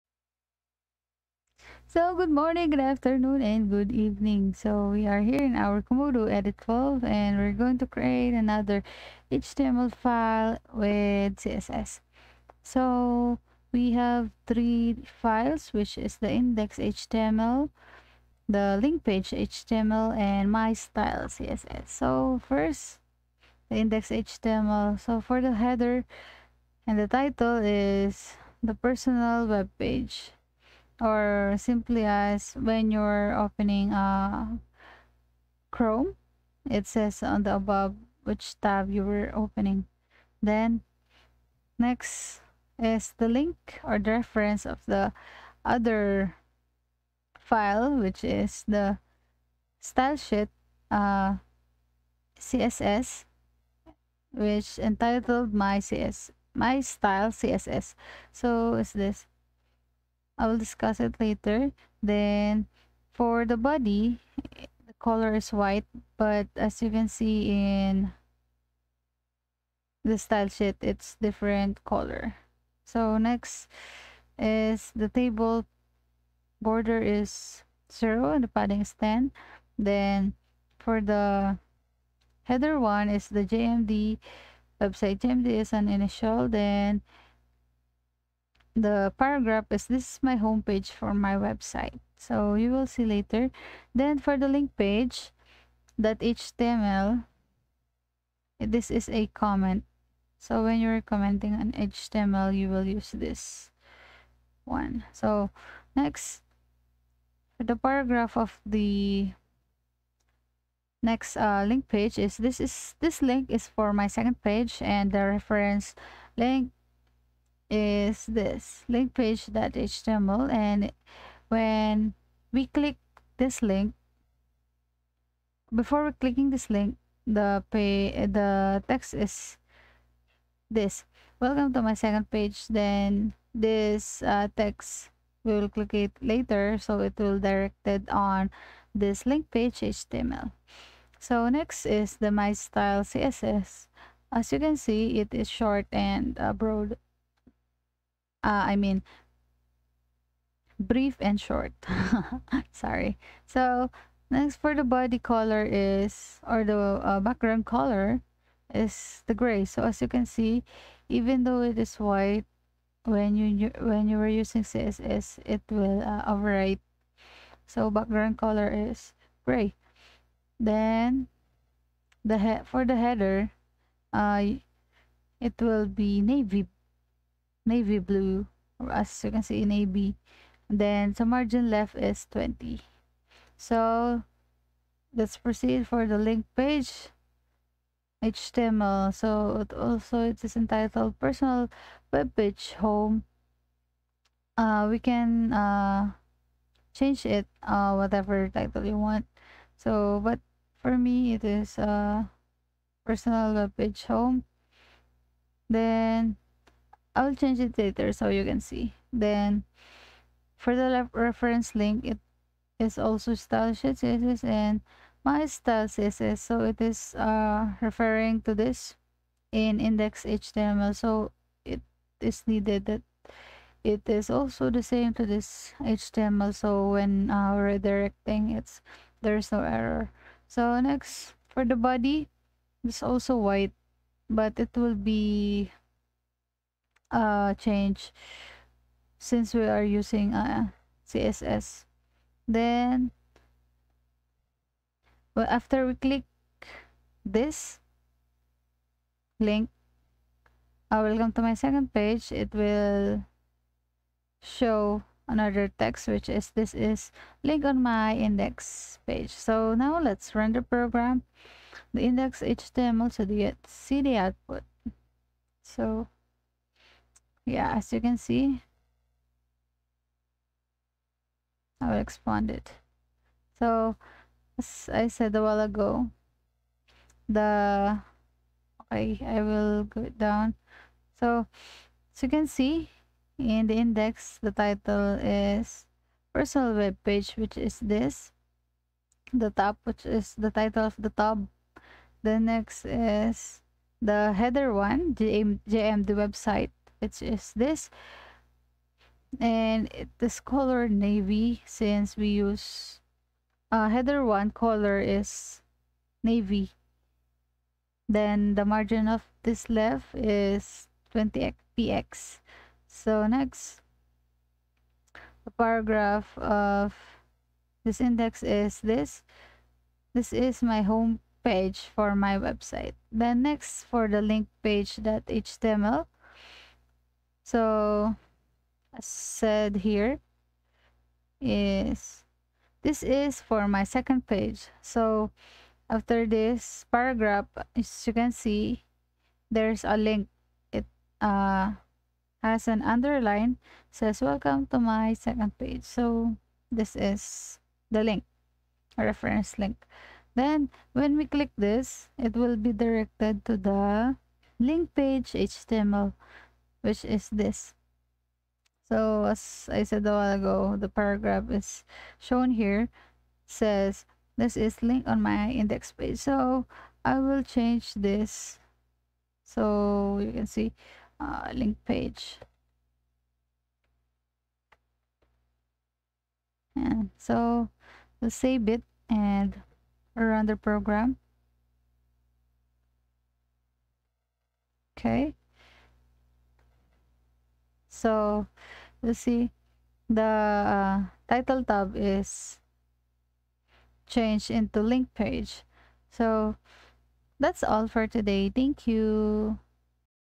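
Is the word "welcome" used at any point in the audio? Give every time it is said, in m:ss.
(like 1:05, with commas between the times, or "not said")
2:11, 5:44.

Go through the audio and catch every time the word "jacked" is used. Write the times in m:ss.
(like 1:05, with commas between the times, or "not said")
not said.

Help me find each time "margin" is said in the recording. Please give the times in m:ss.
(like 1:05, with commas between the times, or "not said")
3:01, 5:08.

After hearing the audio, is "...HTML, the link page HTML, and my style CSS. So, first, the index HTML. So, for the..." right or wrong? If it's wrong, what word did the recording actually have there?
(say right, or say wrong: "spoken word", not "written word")
right.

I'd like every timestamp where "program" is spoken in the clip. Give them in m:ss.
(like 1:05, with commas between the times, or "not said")
4:20, 6:20.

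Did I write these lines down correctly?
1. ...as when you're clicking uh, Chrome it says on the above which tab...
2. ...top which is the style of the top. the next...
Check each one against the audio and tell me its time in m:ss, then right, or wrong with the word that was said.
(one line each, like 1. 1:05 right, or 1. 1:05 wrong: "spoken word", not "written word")
1. 0:32 wrong: "opening", not "clicking"
2. 4:49 wrong: "title", not "style".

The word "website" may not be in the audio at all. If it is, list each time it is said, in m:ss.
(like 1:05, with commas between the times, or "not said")
1:24, 1:31, 4:56, 5:22.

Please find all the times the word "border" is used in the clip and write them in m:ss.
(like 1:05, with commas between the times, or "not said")
1:16.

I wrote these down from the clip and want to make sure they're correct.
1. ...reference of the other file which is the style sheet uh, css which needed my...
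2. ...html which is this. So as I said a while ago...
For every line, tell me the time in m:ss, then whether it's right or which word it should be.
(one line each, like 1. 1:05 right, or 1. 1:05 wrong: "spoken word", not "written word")
1. 0:44 wrong: "entitled", not "needed"
2. 5:55 right.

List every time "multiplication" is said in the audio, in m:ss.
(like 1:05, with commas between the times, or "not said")
not said.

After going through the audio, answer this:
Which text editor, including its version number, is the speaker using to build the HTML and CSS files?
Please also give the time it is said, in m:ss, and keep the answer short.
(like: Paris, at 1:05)
Komodo Edit 12, at 0:05.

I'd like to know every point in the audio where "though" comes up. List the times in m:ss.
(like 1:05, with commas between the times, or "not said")
2:41.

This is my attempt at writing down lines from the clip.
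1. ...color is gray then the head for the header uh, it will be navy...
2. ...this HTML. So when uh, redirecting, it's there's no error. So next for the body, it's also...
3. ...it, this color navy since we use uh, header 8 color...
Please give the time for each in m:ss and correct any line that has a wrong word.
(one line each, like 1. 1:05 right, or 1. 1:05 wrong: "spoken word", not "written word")
1. 2:48 right
2. 3:45 right
3. 4:59 wrong: "1", not "8".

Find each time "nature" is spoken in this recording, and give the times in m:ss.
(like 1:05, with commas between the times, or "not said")
not said.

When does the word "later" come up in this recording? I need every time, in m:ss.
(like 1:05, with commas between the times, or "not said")
1:01, 1:33, 2:16, 3:27.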